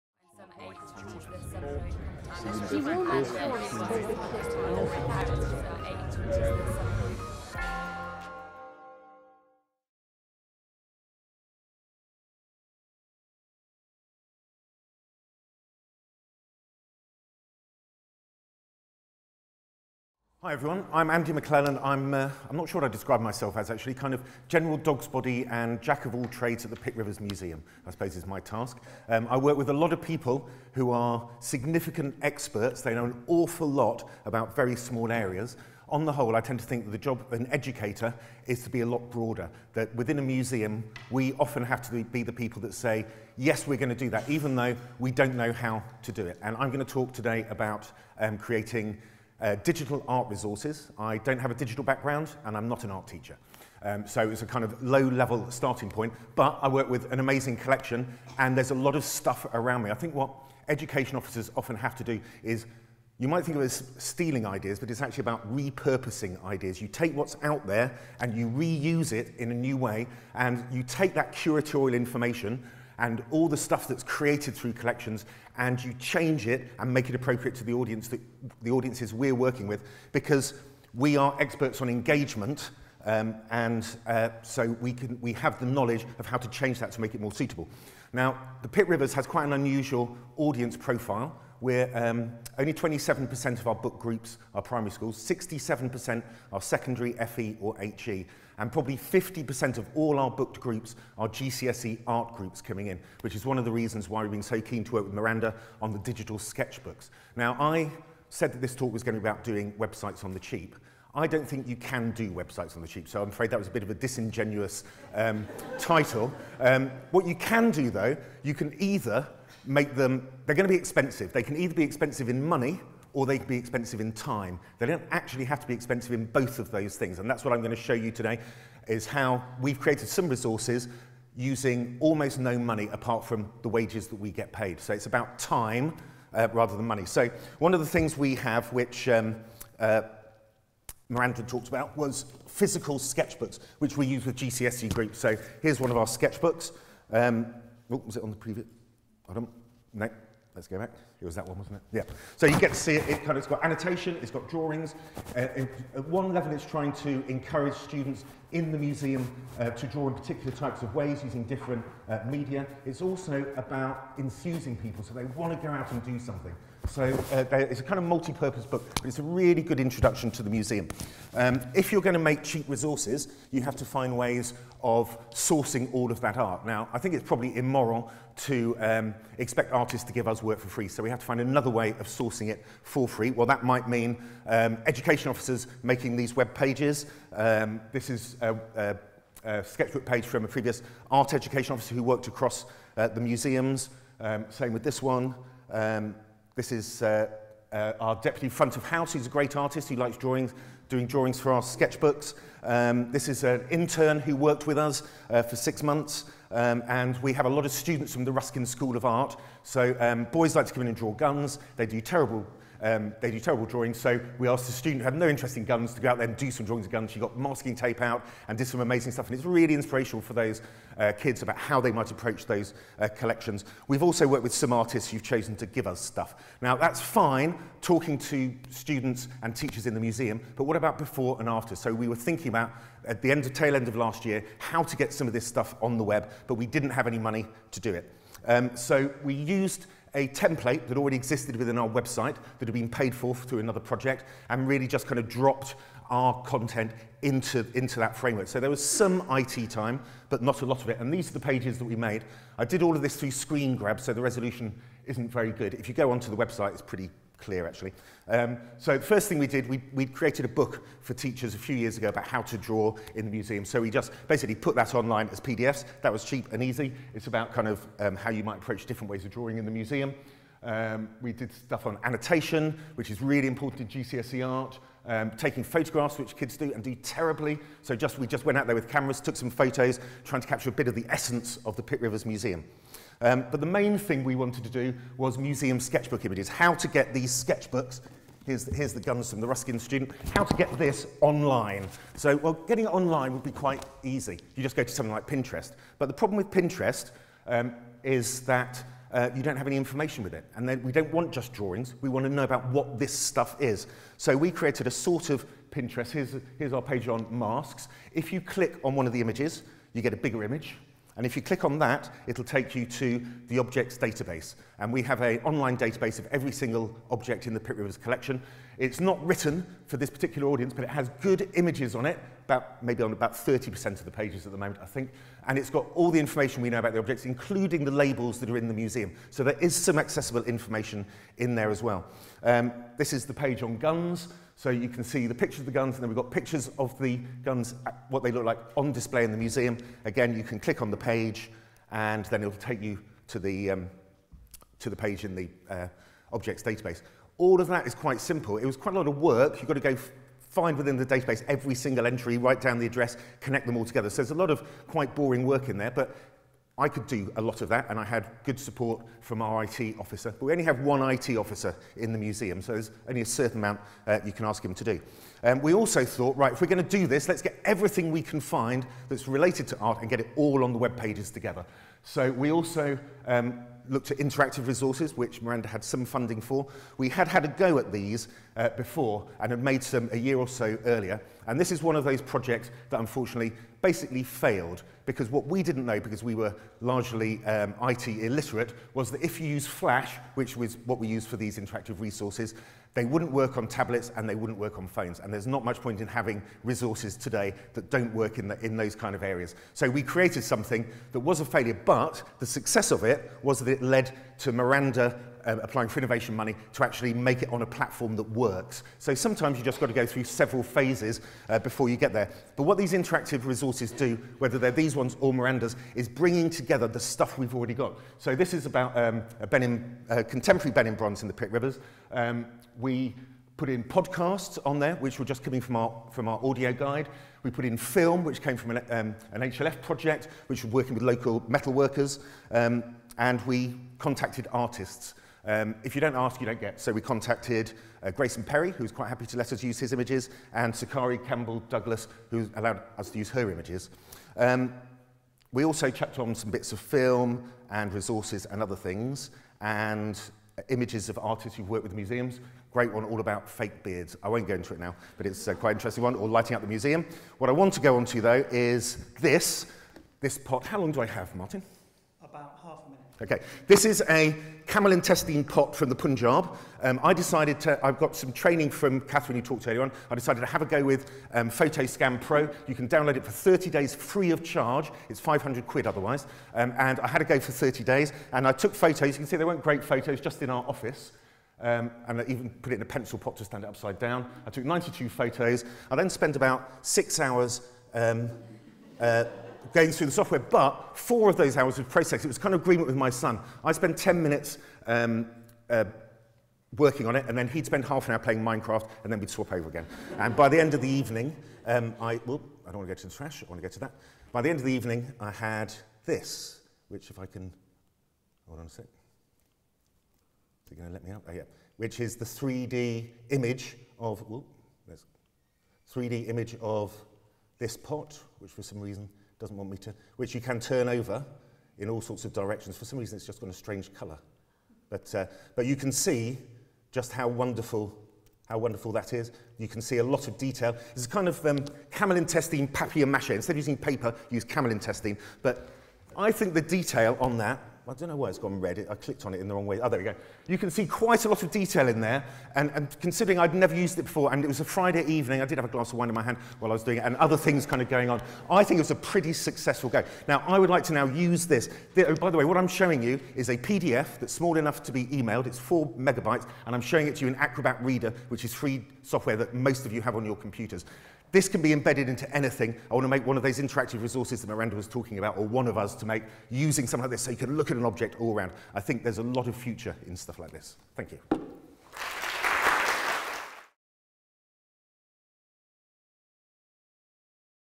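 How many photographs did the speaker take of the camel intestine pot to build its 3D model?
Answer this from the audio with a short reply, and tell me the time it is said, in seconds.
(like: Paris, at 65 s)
92, at 484 s.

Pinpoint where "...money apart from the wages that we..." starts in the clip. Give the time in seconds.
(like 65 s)
132 s.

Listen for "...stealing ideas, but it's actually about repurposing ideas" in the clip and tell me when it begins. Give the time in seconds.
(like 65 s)
63 s.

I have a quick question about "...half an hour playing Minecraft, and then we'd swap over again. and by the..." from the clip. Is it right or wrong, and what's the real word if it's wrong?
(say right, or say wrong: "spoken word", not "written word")
right.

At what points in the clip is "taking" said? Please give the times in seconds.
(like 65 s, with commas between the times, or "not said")
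275 s.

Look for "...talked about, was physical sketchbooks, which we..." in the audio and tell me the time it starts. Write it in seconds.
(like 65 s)
141 s.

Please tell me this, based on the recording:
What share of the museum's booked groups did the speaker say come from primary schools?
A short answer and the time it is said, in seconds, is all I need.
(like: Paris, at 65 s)
27%, at 92 s.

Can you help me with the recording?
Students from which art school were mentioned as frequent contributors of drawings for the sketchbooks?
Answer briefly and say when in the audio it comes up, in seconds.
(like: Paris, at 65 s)
Ruskin School of Art, at 208 s.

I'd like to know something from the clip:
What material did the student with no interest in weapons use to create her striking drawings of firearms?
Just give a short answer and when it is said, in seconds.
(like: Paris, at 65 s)
masking tape, at 217 s.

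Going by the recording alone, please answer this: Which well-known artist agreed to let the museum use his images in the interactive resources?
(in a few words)
Grayson Perry.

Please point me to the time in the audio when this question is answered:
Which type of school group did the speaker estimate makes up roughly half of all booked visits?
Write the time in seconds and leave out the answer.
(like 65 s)
101 s.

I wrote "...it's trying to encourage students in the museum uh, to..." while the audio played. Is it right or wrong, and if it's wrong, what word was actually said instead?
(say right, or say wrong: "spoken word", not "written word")
right.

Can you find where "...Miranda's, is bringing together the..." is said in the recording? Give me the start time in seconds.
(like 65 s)
415 s.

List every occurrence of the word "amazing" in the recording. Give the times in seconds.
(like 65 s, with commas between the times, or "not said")
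57 s, 218 s.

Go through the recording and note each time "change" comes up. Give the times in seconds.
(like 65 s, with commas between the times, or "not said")
75 s, 86 s.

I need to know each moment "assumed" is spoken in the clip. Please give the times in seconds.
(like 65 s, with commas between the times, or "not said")
not said.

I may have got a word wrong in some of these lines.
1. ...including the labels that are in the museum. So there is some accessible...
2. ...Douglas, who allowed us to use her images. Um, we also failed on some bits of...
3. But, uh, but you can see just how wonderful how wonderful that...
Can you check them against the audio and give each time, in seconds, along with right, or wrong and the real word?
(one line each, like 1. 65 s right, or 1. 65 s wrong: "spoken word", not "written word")
1. 327 s right
2. 441 s wrong: "checked", not "failed"
3. 524 s right.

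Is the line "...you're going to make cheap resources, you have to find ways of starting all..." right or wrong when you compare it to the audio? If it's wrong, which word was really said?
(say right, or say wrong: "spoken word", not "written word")
wrong: "sourcing", not "starting".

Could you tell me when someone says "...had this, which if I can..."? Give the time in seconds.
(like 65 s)
505 s.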